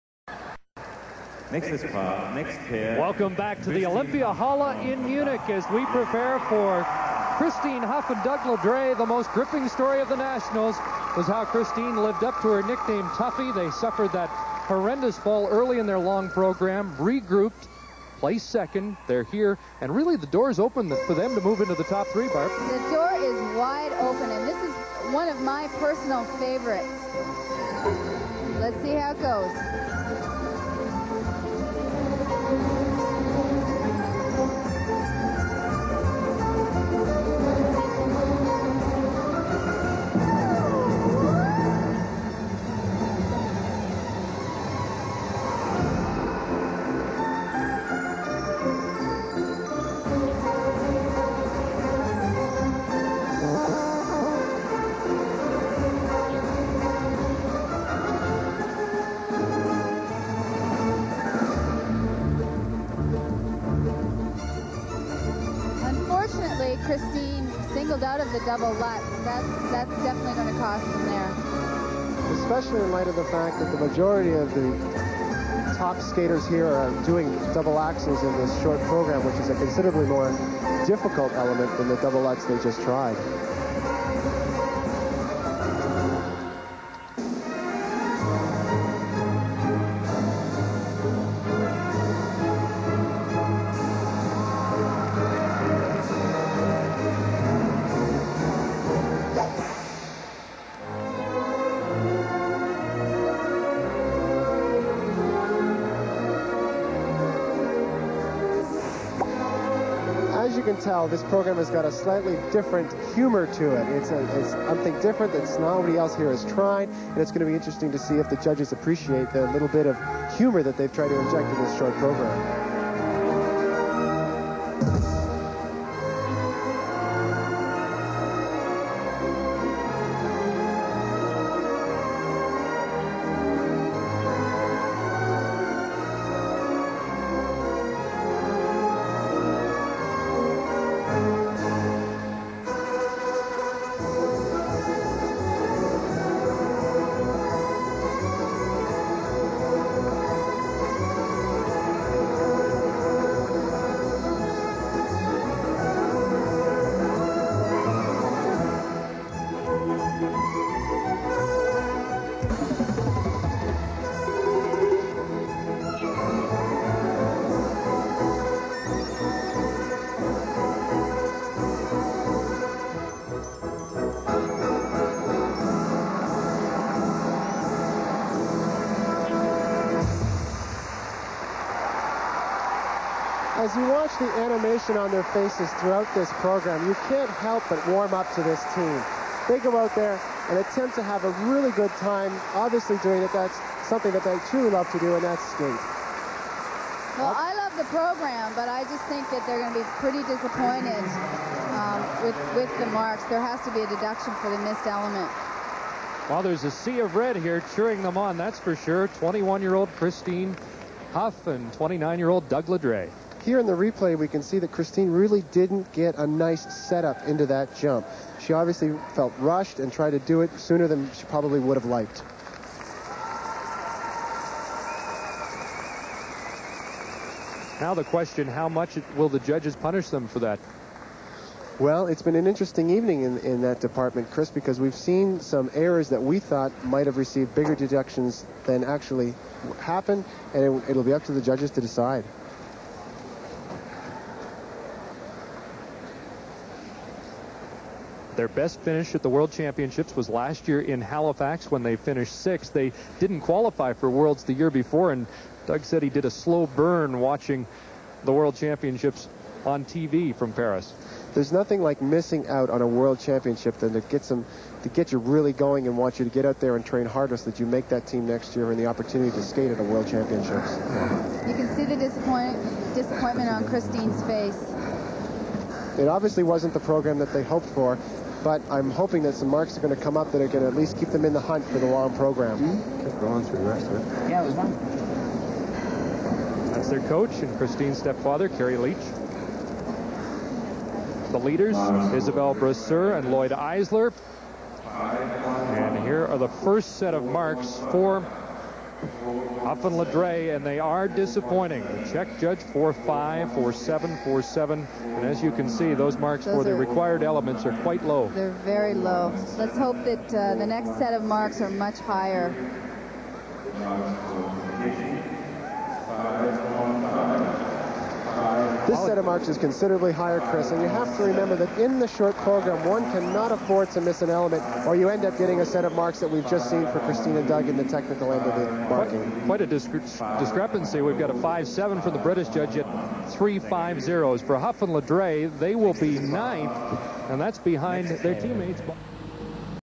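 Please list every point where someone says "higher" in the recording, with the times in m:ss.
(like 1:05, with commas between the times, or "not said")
5:11, 5:20.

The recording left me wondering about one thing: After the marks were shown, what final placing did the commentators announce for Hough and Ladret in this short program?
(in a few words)
9th.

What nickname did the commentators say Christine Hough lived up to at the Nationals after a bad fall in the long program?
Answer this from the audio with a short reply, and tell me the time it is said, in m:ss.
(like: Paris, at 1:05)
Tuffy, at 0:13.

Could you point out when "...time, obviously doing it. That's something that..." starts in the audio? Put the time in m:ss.
3:12.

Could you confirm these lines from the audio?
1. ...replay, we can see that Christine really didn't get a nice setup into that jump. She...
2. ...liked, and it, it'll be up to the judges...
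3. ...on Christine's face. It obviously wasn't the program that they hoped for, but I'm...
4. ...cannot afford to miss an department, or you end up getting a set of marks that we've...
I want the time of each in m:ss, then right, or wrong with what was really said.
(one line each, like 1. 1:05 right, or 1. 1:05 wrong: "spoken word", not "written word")
1. 3:33 right
2. 3:59 wrong: "happened", not "liked"
3. 4:33 right
4. 5:23 wrong: "element", not "department".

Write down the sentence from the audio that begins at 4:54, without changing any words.
And here are the first set of marks for Hough and Ladret, and they are disappointing.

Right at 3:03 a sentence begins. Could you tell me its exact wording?
As you watch the animation on their faces throughout this program, you can't help but warm up to this team.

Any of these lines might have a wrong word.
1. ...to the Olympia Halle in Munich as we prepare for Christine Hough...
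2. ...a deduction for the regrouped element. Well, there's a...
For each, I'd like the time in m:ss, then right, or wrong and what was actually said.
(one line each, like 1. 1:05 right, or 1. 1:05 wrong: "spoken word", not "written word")
1. 0:03 right
2. 3:23 wrong: "missed", not "regrouped".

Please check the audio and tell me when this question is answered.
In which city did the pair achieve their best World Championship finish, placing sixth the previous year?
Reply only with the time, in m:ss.
4:10.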